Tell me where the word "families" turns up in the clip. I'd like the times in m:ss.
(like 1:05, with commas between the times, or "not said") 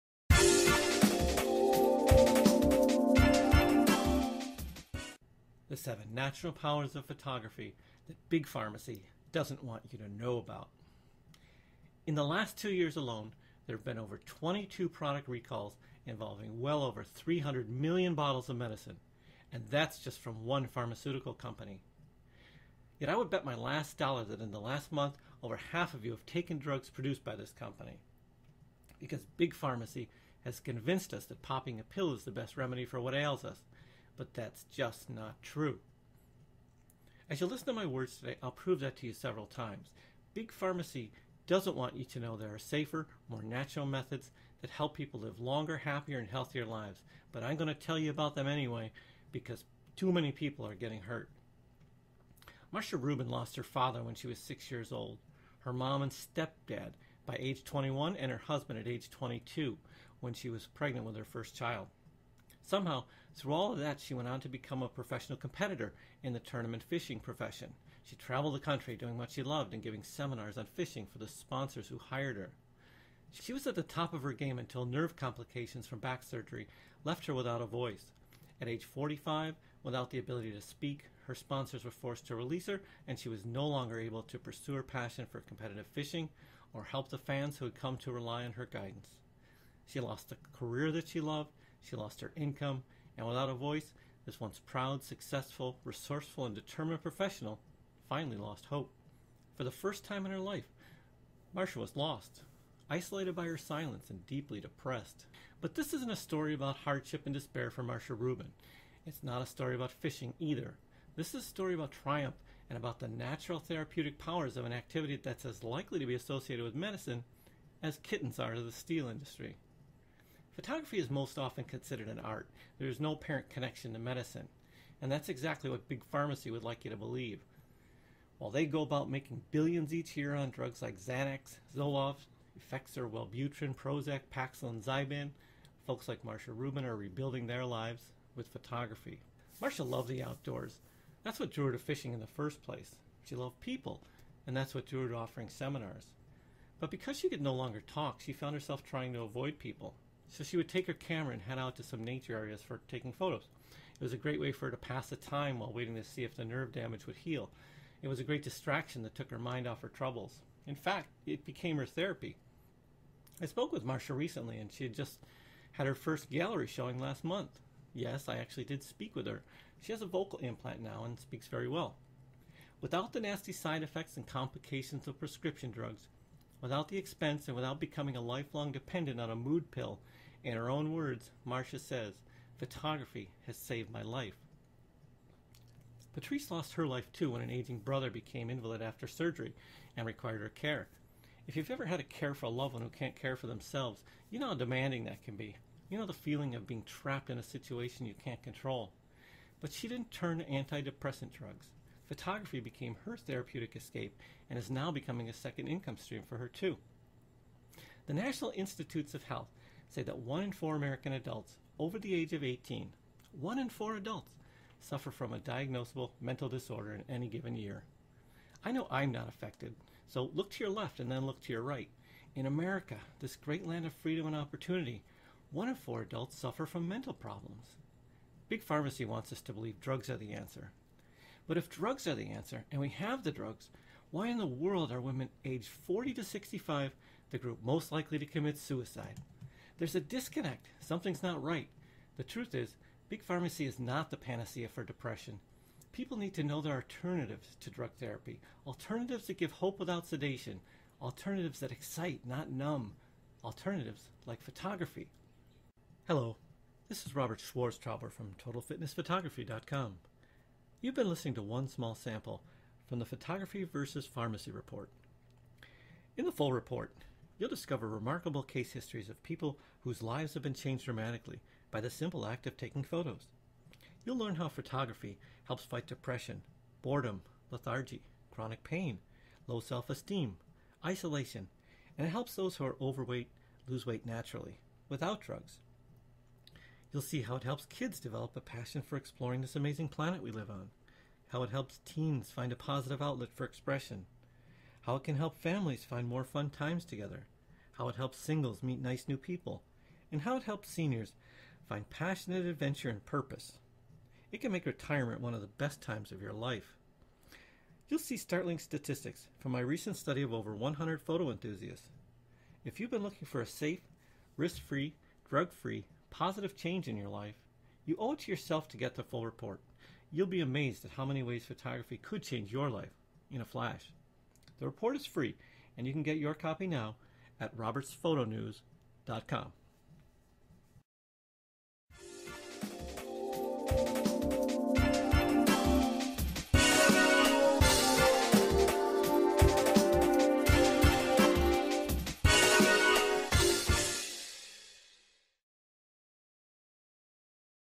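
4:55.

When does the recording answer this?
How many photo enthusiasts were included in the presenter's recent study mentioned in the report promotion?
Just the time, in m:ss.
5:10.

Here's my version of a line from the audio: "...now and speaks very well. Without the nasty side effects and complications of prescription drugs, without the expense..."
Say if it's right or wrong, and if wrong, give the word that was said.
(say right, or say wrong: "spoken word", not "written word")
right.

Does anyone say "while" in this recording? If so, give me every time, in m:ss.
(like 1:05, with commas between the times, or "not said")
2:08, 2:35.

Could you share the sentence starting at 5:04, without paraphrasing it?
It can make retirement one of the best times of your life.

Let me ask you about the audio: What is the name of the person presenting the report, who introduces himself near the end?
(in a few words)
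Robert Schwarztrauber.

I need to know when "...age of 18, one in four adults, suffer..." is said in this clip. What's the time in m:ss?
3:32.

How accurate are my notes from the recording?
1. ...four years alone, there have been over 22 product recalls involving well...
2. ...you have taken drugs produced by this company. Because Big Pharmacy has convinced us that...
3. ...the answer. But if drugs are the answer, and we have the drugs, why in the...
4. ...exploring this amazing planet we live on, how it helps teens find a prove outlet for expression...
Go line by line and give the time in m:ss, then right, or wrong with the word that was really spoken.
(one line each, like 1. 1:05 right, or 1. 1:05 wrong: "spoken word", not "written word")
1. 0:12 wrong: "two", not "four"
2. 0:26 right
3. 3:50 right
4. 4:48 wrong: "positive", not "prove".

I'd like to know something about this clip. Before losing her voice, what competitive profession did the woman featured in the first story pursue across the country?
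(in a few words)
tournament fishing.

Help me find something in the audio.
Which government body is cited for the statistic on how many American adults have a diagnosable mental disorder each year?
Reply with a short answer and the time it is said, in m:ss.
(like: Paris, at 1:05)
National Institutes of Health, at 3:28.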